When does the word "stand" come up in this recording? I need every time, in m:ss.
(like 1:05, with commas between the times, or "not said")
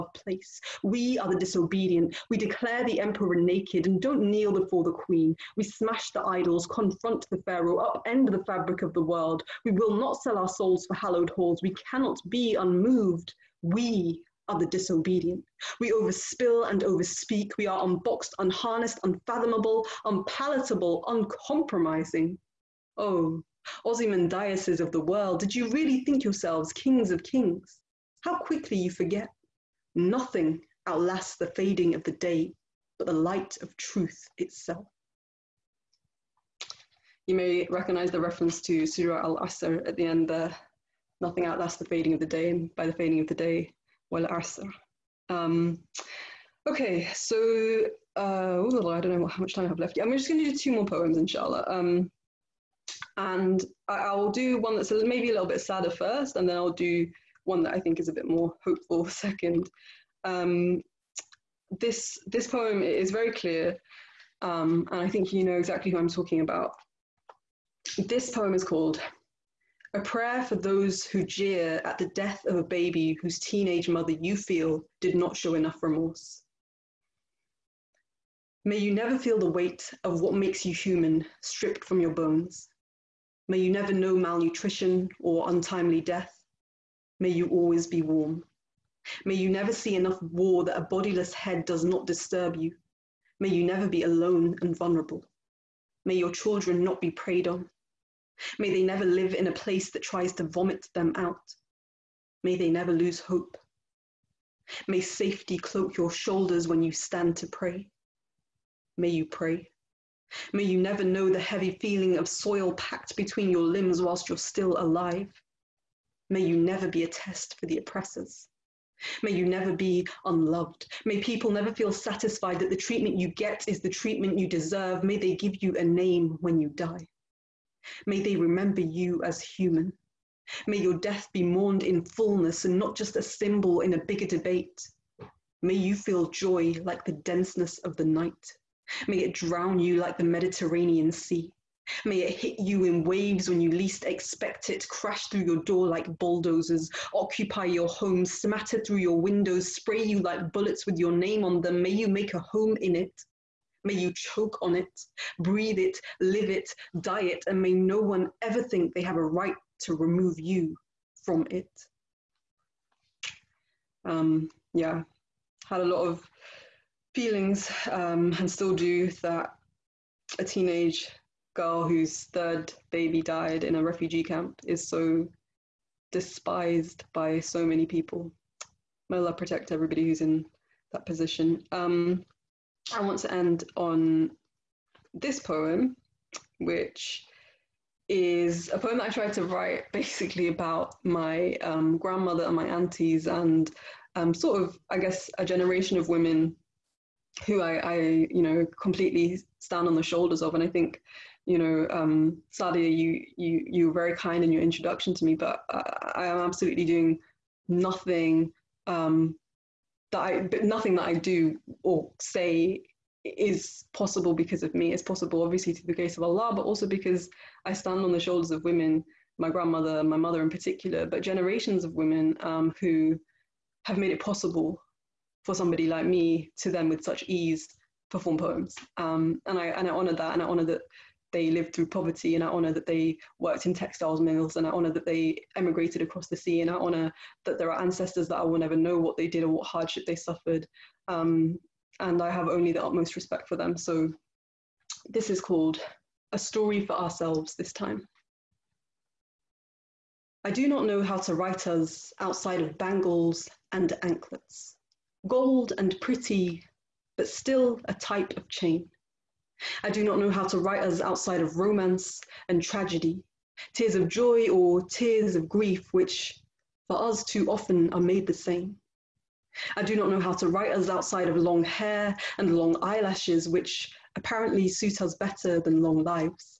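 1:46, 3:19, 3:37.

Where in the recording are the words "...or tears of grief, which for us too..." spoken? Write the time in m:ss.
4:24.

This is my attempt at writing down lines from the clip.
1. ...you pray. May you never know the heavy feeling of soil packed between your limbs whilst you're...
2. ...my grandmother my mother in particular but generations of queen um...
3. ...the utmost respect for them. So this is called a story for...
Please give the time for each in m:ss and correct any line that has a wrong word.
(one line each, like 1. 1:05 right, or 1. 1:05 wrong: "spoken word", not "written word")
1. 1:49 right
2. 3:39 wrong: "women", not "queen"
3. 4:02 right.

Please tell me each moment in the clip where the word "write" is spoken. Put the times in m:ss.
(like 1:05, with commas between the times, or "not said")
3:09, 4:11, 4:20, 4:30.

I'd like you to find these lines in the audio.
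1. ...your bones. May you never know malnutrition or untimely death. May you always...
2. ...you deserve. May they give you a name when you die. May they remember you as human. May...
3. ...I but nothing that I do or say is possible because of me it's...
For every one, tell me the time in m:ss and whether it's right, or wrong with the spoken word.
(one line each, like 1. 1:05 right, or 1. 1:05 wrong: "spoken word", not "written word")
1. 1:21 right
2. 2:04 right
3. 3:30 right.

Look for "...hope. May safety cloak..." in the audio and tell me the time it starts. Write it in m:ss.
1:43.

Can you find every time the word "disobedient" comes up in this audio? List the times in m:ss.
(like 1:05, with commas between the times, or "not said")
0:01, 0:14.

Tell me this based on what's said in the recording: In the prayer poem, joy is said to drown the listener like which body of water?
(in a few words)
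Mediterranean Sea.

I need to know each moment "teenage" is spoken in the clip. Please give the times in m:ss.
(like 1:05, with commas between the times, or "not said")
1:13, 2:50.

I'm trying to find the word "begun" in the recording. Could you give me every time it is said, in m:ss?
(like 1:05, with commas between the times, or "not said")
not said.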